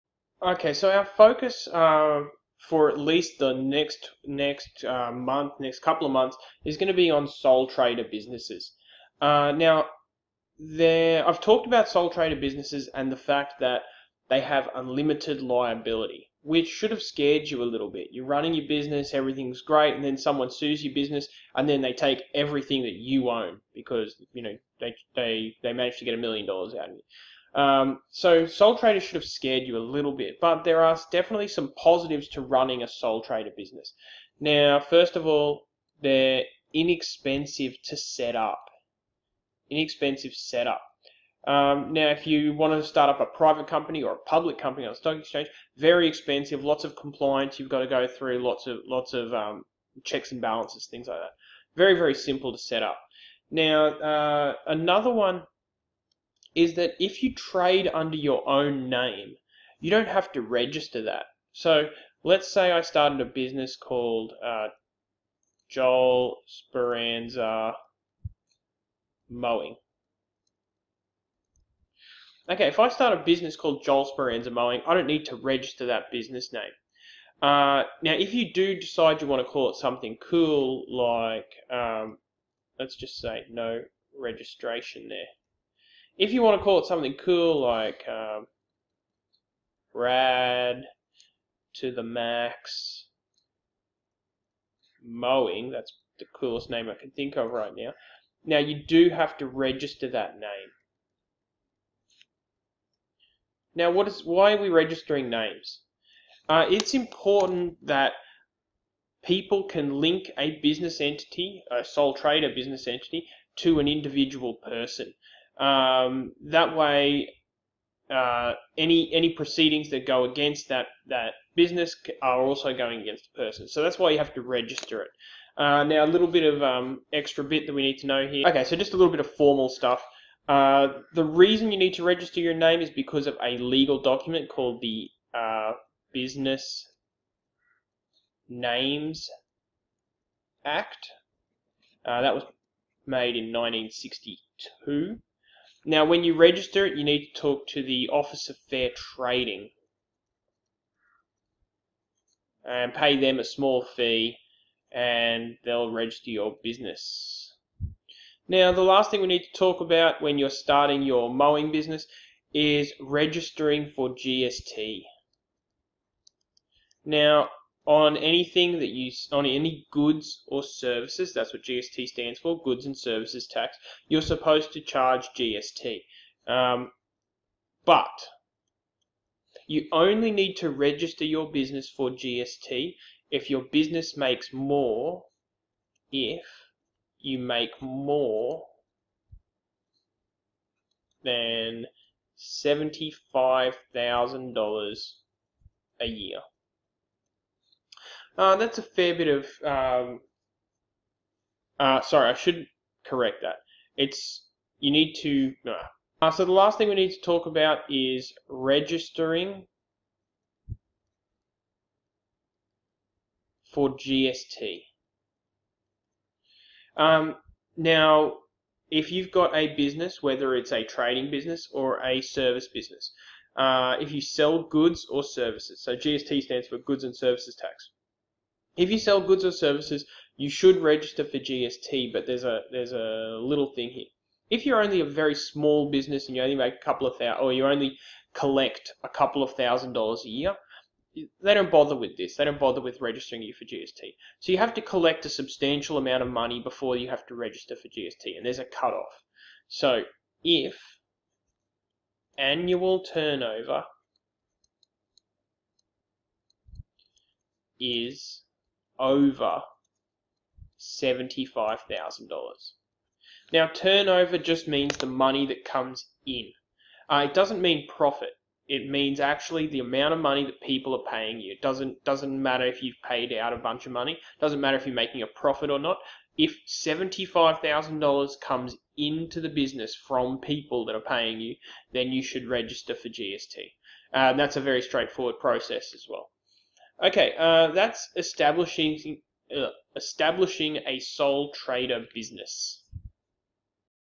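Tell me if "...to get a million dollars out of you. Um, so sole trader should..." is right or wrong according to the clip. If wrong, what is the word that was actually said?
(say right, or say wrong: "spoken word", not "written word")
right.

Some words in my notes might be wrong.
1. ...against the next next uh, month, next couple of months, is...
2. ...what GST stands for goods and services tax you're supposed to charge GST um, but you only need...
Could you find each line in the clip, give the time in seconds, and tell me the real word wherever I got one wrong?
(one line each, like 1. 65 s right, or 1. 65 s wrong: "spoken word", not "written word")
1. 2 s wrong: "least", not "against"
2. 171 s right.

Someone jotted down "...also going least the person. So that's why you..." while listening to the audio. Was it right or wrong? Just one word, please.
wrong.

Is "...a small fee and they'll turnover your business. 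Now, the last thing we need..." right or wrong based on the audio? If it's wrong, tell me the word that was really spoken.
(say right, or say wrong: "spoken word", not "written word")
wrong: "register", not "turnover".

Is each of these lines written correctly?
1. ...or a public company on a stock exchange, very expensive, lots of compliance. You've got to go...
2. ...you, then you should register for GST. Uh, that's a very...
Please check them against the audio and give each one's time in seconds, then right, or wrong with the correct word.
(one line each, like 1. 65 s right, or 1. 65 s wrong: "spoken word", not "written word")
1. 44 s right
2. 281 s right.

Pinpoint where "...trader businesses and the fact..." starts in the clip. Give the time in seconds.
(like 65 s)
12 s.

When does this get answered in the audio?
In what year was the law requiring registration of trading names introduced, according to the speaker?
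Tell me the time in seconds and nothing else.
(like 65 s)
143 s.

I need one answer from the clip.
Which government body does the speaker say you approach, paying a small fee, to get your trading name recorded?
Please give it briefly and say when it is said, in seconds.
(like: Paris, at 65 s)
Office of Fair Trading, at 148 s.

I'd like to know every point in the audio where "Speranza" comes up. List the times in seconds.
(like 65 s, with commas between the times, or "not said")
66 s, 74 s.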